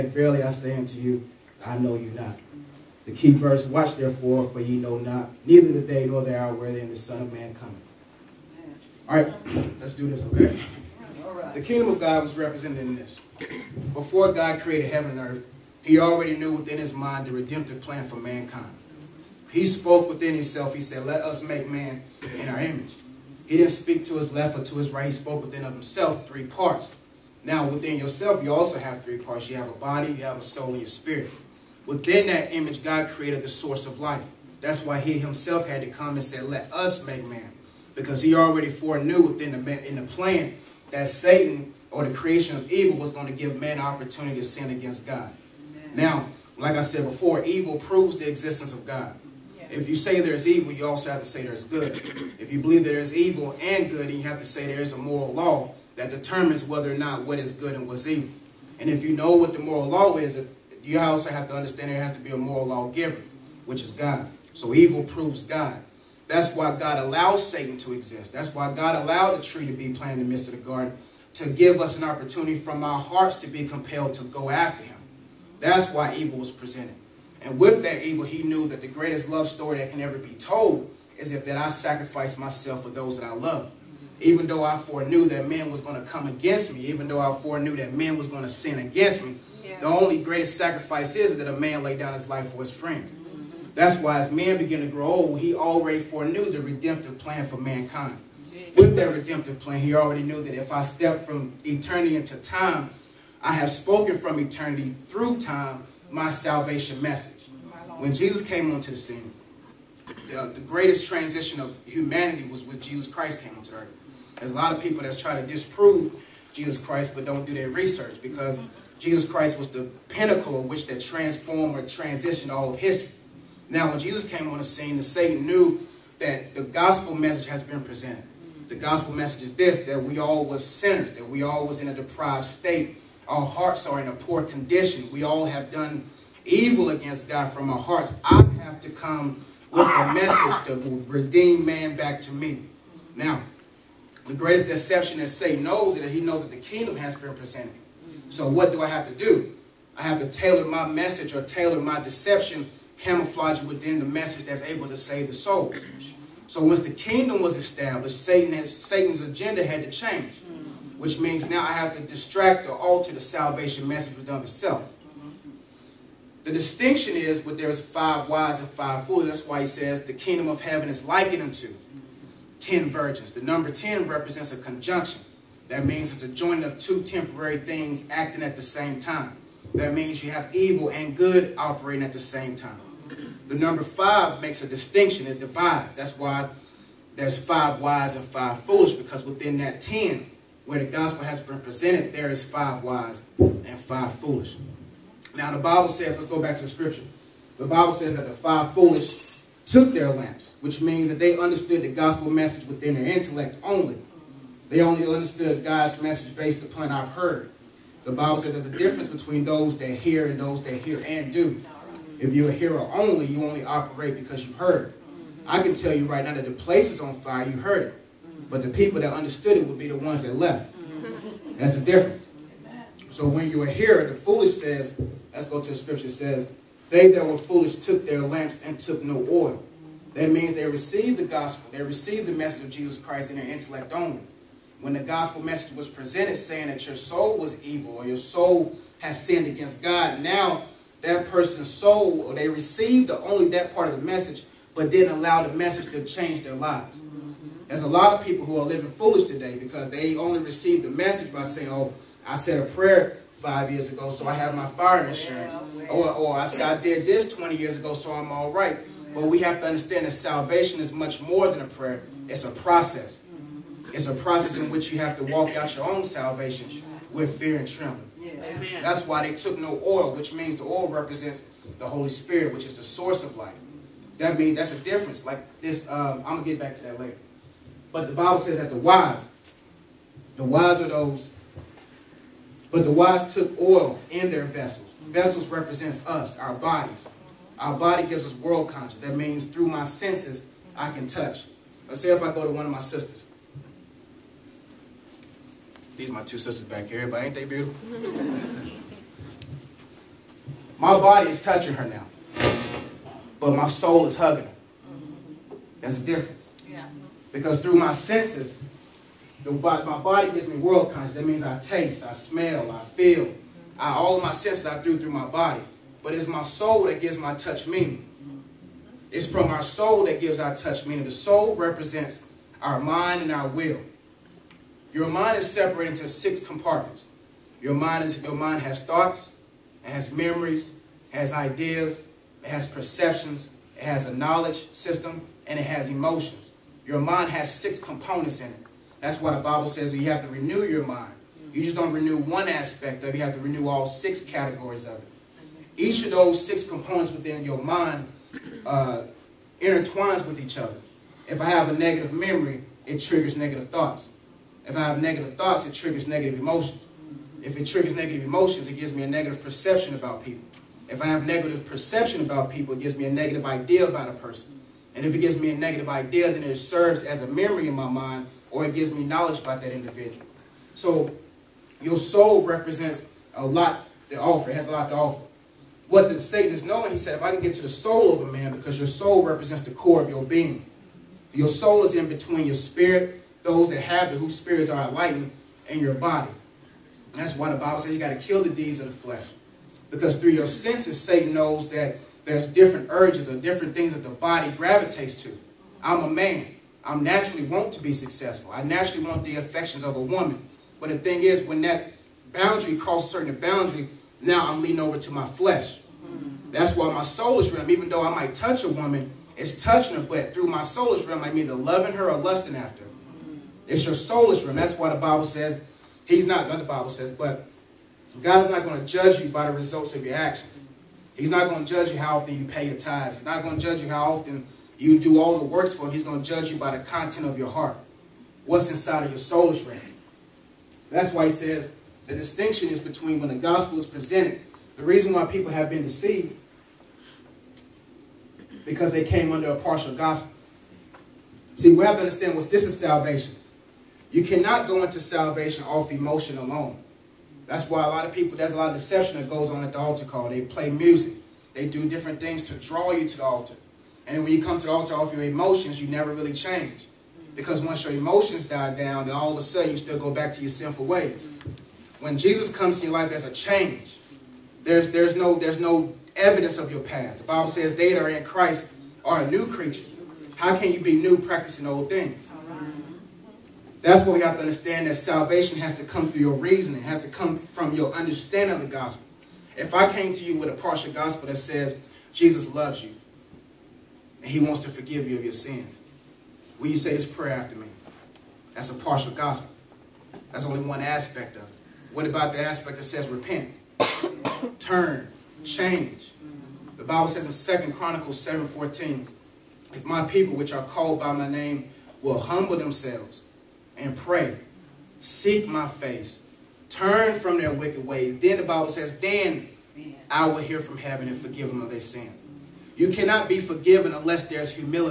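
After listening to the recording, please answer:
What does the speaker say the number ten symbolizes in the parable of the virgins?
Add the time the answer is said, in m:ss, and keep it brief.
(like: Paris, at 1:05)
a conjunction, at 2:54.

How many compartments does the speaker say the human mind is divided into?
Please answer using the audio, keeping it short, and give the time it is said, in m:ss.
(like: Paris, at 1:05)
6, at 5:26.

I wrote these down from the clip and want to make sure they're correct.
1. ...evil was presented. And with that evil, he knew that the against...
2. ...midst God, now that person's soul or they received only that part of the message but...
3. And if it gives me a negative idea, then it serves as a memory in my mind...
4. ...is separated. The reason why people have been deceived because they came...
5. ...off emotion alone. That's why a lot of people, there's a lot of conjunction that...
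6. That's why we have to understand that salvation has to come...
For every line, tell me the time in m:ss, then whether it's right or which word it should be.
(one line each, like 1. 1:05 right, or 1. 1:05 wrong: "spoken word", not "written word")
1. 1:16 wrong: "greatest", not "against"
2. 3:59 wrong: "against", not "midst"
3. 6:04 right
4. 7:13 wrong: "presented", not "separated"
5. 7:25 wrong: "deception", not "conjunction"
6. 7:53 right.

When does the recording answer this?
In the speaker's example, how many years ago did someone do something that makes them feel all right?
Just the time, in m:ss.
4:17.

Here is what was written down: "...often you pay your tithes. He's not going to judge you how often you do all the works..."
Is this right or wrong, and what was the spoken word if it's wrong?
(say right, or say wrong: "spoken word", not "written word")
right.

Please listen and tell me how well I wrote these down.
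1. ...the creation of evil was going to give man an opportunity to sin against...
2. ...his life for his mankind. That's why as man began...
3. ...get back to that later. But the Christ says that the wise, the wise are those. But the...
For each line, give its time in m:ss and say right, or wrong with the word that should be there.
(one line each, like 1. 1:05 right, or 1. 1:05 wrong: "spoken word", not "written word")
1. 0:42 right
2. 1:32 wrong: "friend", not "mankind"
3. 4:36 wrong: "Bible", not "Christ".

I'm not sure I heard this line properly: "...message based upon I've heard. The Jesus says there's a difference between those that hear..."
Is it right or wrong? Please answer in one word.
wrong.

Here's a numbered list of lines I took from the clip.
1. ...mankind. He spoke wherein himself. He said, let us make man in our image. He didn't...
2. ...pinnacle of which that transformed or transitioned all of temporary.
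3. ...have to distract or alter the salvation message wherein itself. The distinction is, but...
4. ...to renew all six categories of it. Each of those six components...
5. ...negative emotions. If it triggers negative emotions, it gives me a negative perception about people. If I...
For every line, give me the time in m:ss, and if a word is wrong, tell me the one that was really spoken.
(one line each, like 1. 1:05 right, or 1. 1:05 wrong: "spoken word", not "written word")
1. 0:18 wrong: "within", not "wherein"
2. 2:00 wrong: "history", not "temporary"
3. 2:41 wrong: "within", not "wherein"
4. 5:43 right
5. 5:56 right.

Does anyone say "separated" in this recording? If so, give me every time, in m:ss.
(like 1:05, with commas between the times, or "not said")
5:25.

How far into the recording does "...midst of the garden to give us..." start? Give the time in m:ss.
1:10.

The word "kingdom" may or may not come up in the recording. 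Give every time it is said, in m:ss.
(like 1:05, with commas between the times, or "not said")
0:11, 2:26, 2:36, 2:50.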